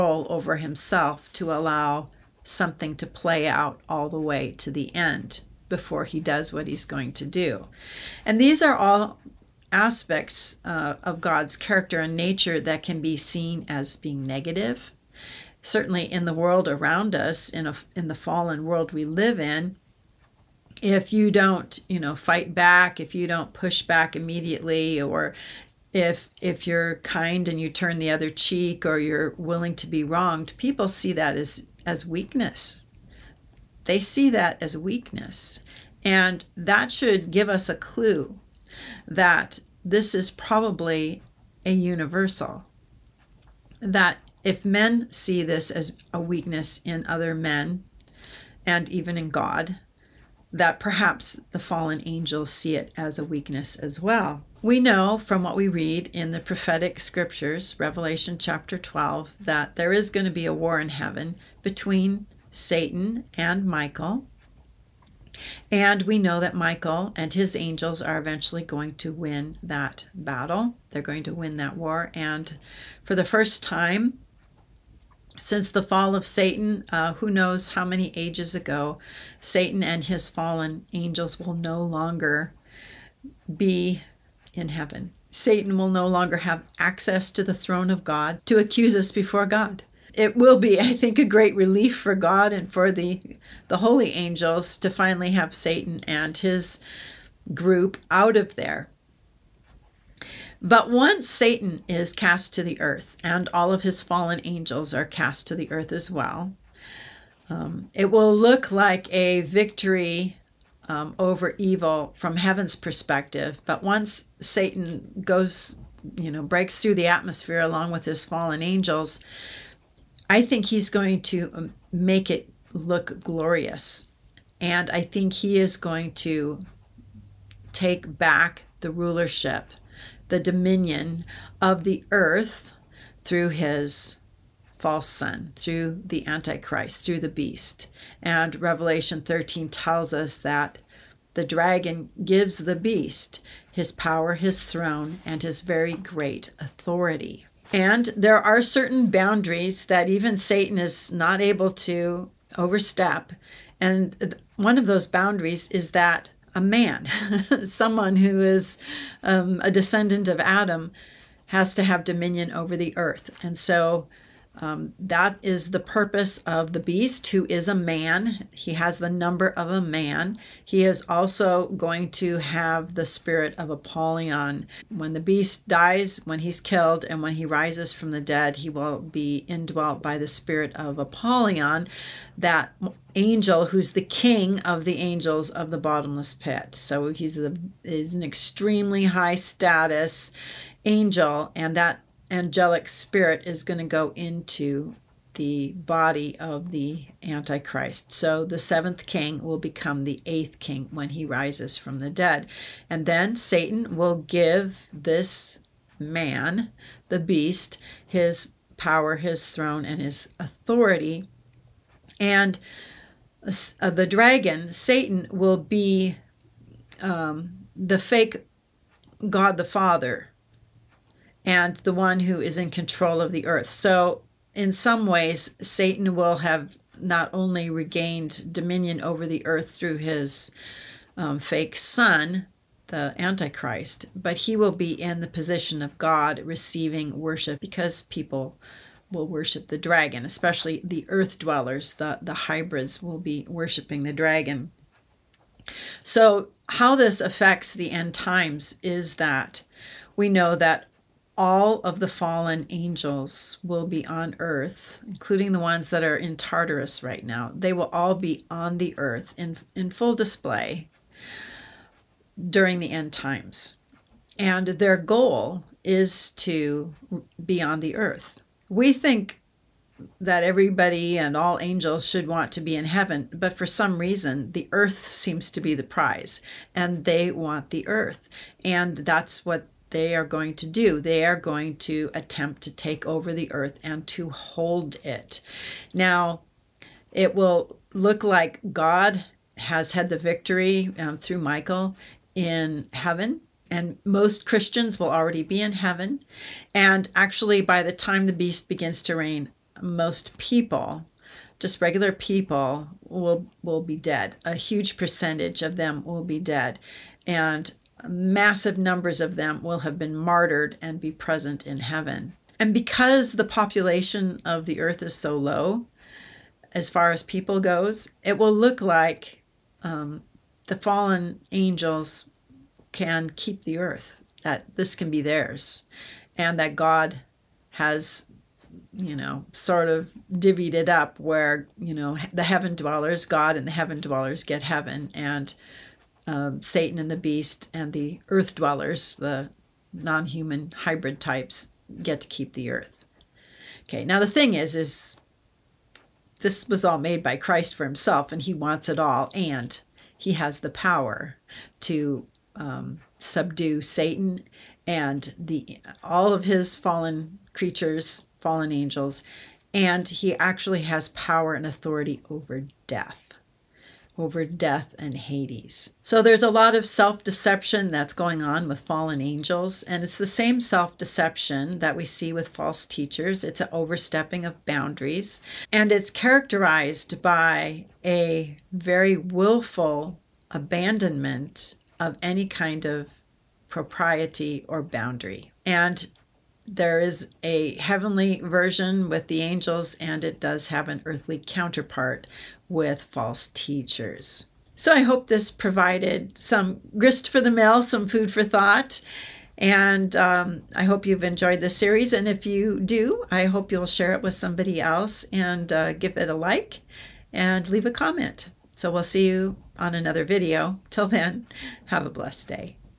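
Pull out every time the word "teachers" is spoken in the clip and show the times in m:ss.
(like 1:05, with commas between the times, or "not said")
6:12, 6:33.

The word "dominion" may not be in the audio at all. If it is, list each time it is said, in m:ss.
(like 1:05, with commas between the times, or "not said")
2:10, 2:42, 3:48.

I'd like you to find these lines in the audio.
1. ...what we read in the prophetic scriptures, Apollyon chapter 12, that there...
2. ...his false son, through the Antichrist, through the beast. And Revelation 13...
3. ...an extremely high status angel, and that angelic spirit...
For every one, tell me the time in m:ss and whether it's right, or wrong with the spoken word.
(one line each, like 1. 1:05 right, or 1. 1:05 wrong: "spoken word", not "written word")
1. 0:55 wrong: "Revelation", not "Apollyon"
2. 2:13 right
3. 3:08 right.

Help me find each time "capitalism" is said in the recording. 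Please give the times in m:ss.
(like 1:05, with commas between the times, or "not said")
not said.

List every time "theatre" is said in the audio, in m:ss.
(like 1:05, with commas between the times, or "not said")
not said.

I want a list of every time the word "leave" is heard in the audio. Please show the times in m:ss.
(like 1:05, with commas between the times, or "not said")
6:47.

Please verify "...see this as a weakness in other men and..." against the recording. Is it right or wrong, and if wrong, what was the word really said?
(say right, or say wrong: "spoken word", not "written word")
right.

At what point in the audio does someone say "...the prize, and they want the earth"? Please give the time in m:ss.
4:35.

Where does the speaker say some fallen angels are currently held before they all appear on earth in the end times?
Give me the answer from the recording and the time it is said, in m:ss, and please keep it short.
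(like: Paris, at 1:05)
Tartarus, at 4:16.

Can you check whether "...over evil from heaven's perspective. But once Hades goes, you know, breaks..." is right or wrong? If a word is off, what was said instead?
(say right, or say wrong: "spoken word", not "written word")
wrong: "Satan", not "Hades".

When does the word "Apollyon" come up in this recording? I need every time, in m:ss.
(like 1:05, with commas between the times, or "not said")
2:53, 3:00.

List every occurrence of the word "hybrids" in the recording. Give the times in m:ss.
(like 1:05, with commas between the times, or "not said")
4:02, 5:40.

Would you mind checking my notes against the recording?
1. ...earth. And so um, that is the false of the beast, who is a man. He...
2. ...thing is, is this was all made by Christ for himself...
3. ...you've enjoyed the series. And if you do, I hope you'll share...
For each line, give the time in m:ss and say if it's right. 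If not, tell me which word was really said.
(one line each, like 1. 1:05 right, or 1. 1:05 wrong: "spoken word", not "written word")
1. 2:42 wrong: "purpose", not "false"
2. 5:44 right
3. 6:41 right.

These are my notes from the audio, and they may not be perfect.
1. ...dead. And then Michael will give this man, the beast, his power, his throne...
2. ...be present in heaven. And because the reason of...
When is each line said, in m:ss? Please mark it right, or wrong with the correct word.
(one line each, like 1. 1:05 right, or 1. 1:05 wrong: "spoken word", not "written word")
1. 3:22 wrong: "Satan", not "Michael"
2. 5:10 wrong: "population", not "reason".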